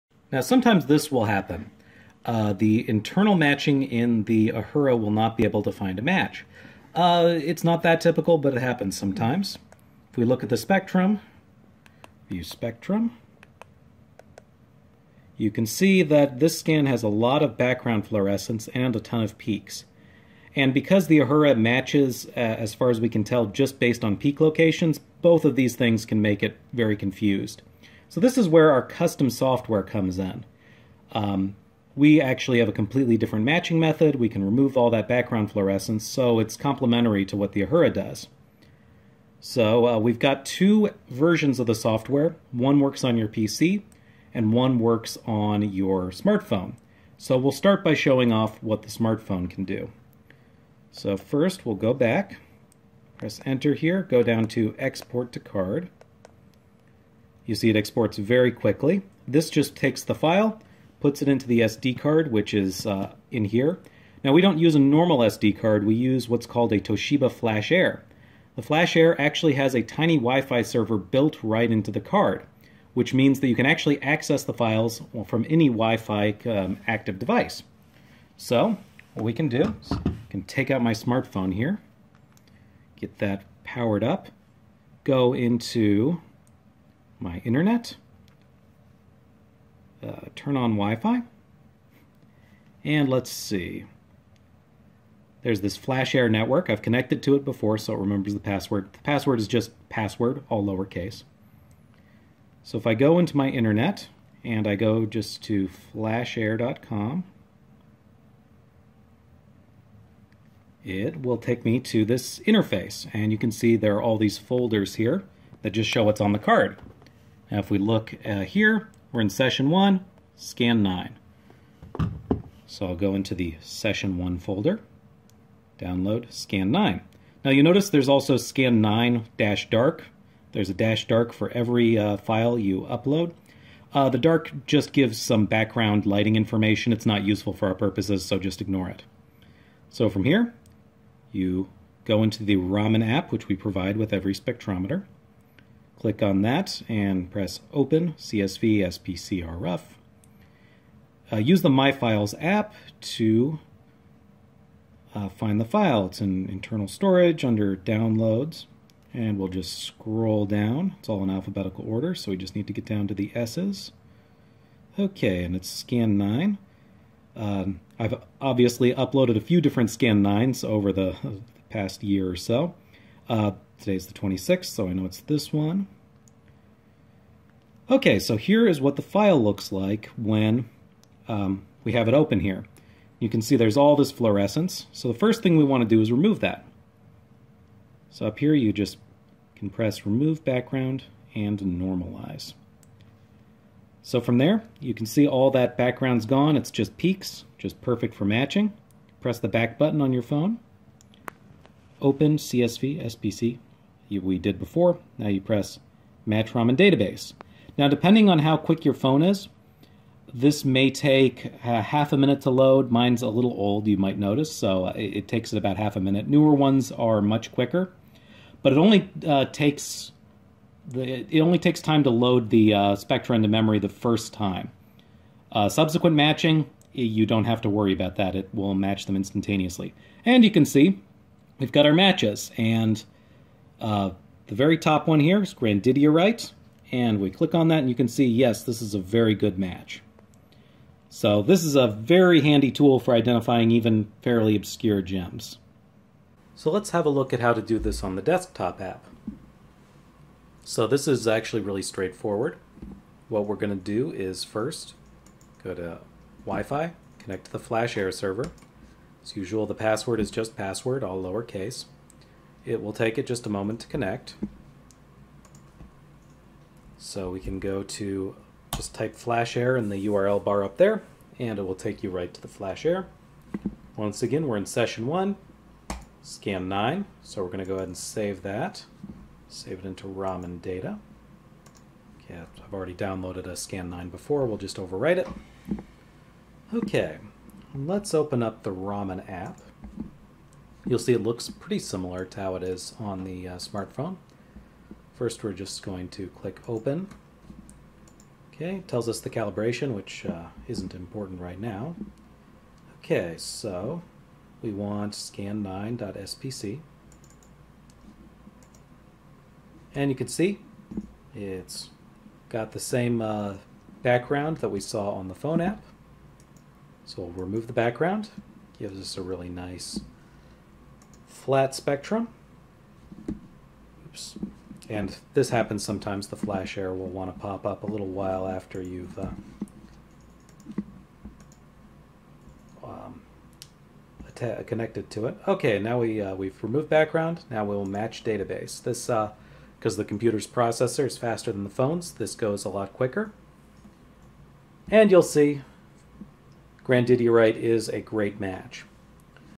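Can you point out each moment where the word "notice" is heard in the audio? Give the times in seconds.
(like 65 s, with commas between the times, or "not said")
127 s, 214 s.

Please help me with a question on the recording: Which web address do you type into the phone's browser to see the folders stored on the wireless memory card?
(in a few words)
flashair.com.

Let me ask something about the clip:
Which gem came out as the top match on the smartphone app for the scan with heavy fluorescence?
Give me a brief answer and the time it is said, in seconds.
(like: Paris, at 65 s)
Grandidierite, at 235 s.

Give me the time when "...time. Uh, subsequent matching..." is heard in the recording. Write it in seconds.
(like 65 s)
224 s.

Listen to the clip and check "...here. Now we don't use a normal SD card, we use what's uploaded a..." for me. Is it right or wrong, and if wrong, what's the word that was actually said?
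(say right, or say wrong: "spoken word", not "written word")
wrong: "called", not "uploaded".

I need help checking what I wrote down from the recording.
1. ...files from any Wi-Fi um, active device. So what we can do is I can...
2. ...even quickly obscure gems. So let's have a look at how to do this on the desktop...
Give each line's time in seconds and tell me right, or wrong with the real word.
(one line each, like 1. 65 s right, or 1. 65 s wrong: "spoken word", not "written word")
1. 74 s right
2. 243 s wrong: "fairly", not "quickly".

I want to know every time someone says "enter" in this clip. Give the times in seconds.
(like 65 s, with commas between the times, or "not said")
53 s.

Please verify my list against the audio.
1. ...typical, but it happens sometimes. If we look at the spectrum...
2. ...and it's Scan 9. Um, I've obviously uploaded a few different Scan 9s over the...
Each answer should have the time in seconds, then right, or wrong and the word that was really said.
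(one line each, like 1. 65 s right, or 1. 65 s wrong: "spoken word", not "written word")
1. 8 s right
2. 165 s right.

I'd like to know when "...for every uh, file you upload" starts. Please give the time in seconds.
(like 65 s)
131 s.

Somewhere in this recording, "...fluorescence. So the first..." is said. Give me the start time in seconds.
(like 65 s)
184 s.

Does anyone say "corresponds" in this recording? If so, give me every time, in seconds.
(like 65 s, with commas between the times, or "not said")
not said.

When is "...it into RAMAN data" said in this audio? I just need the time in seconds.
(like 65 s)
279 s.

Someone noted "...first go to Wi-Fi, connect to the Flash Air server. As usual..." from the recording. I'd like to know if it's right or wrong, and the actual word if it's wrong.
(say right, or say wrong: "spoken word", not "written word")
right.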